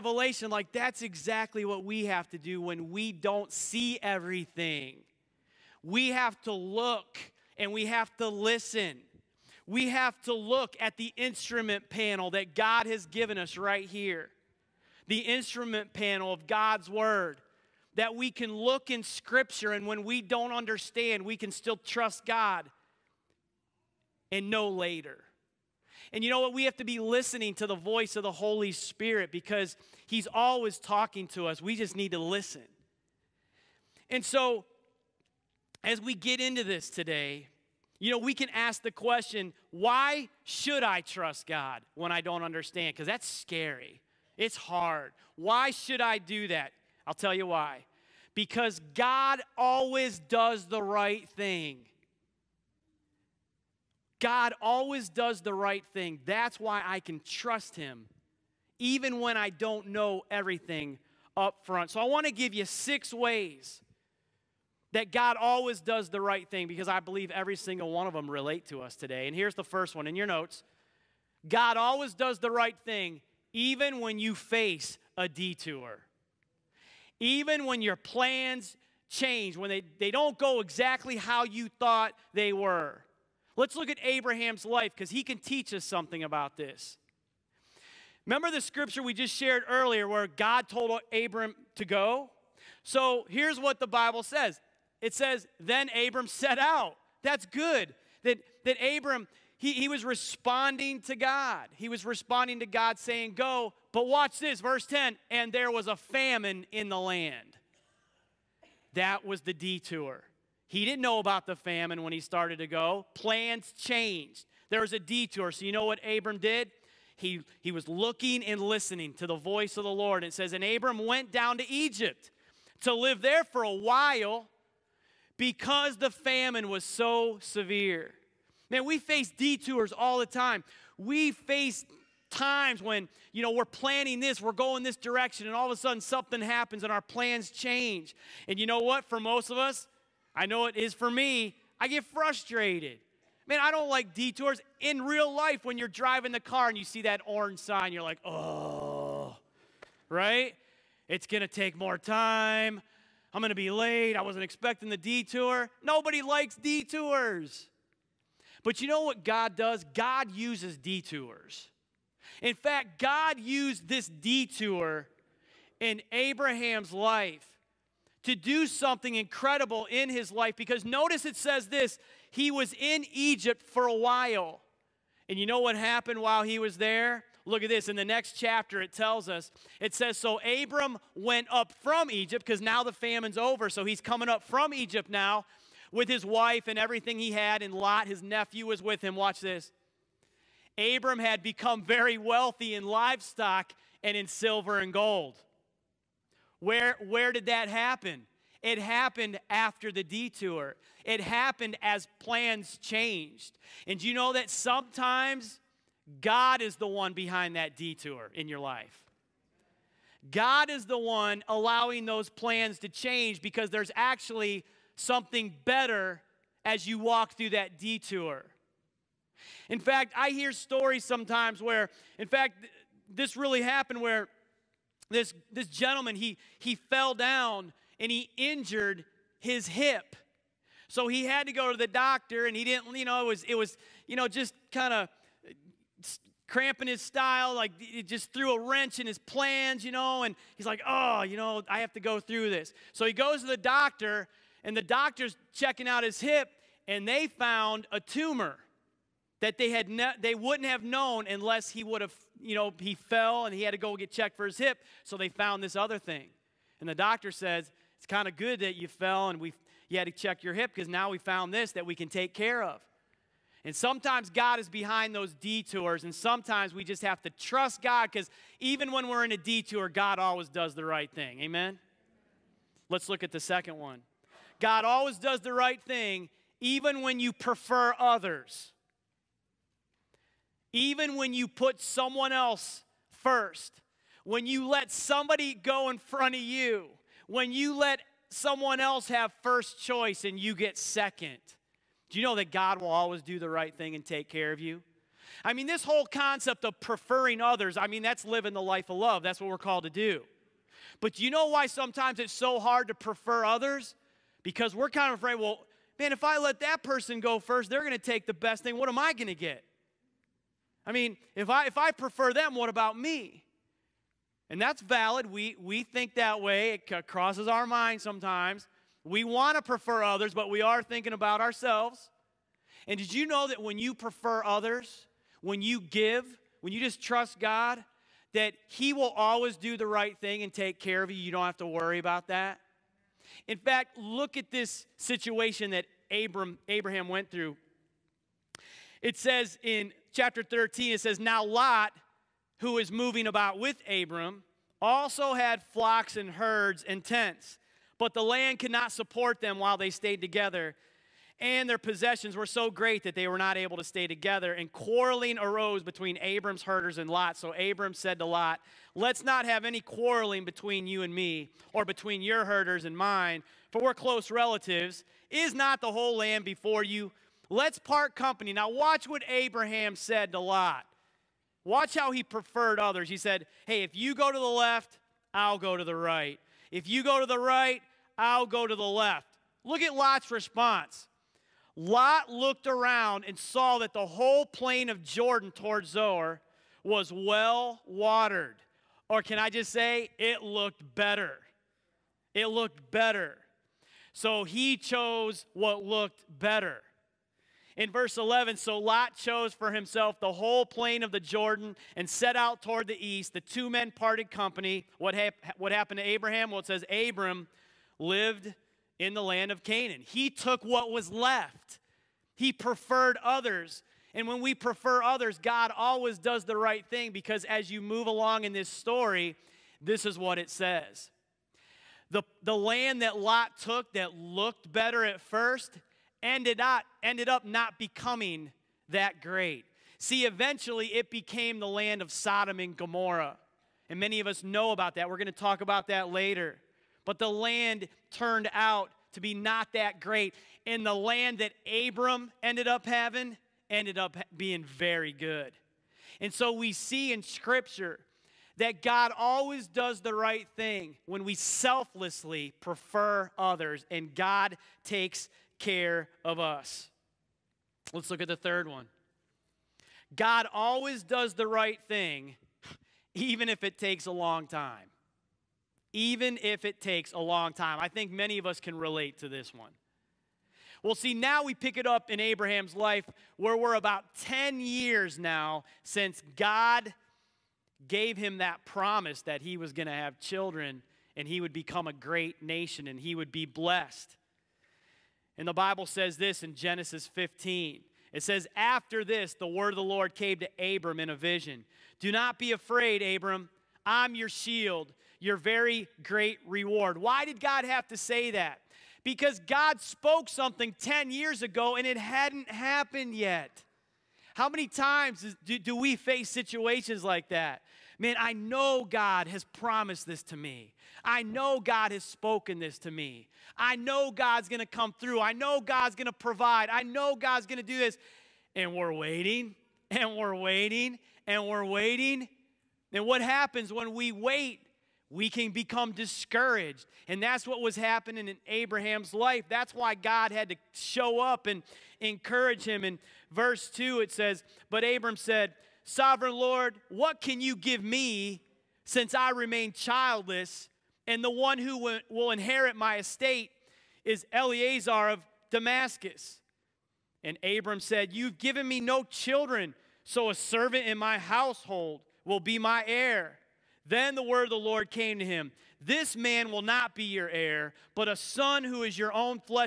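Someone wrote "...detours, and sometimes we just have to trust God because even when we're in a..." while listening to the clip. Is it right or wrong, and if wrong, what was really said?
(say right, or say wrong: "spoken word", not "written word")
right.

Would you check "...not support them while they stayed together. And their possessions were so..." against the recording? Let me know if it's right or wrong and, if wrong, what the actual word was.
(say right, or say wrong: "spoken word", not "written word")
right.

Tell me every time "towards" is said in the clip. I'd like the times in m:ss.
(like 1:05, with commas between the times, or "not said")
6:25, 6:42.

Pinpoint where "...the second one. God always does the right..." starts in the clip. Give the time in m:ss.
4:33.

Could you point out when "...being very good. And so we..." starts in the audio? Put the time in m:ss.
7:24.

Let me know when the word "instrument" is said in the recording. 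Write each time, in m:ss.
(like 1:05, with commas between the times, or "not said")
0:11, 0:15.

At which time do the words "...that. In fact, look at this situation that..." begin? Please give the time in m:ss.
5:32.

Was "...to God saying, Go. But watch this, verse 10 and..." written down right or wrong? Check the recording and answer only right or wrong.
right.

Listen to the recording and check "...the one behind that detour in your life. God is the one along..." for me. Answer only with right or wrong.
wrong.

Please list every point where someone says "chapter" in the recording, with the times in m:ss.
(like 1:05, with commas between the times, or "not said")
2:58, 5:40.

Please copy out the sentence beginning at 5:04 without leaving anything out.
Because we're kind of afraid, well, man, if I let that person go first, they're going to take the best thing.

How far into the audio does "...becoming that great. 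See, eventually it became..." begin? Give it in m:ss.
7:07.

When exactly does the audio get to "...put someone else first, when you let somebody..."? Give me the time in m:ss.
4:41.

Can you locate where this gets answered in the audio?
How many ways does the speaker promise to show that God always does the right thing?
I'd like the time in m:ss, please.
1:02.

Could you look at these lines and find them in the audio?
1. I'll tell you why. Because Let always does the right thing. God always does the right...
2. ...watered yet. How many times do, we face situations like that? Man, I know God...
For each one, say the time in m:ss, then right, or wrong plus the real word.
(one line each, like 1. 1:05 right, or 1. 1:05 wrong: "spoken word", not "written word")
1. 0:47 wrong: "God", not "Let"
2. 8:22 wrong: "happened", not "watered".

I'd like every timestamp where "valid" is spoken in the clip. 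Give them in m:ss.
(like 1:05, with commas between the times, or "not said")
5:14.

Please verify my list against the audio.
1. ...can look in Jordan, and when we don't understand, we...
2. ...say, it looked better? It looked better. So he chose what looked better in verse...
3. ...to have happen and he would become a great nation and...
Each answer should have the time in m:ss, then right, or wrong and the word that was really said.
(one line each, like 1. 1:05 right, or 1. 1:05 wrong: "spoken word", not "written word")
1. 0:18 wrong: "Scripture", not "Jordan"
2. 6:29 right
3. 7:59 wrong: "children", not "happen".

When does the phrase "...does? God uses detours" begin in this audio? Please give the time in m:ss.
2:39.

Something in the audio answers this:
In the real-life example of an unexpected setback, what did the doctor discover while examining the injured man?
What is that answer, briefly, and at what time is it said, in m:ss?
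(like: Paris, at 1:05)
a tumor, at 4:07.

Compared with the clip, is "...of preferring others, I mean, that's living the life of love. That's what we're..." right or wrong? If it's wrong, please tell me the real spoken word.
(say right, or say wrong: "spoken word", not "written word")
right.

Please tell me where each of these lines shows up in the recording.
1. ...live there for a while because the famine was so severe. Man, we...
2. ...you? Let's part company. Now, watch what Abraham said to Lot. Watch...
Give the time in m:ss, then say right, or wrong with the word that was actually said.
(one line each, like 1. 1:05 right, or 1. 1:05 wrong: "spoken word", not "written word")
1. 2:02 right
2. 6:06 right.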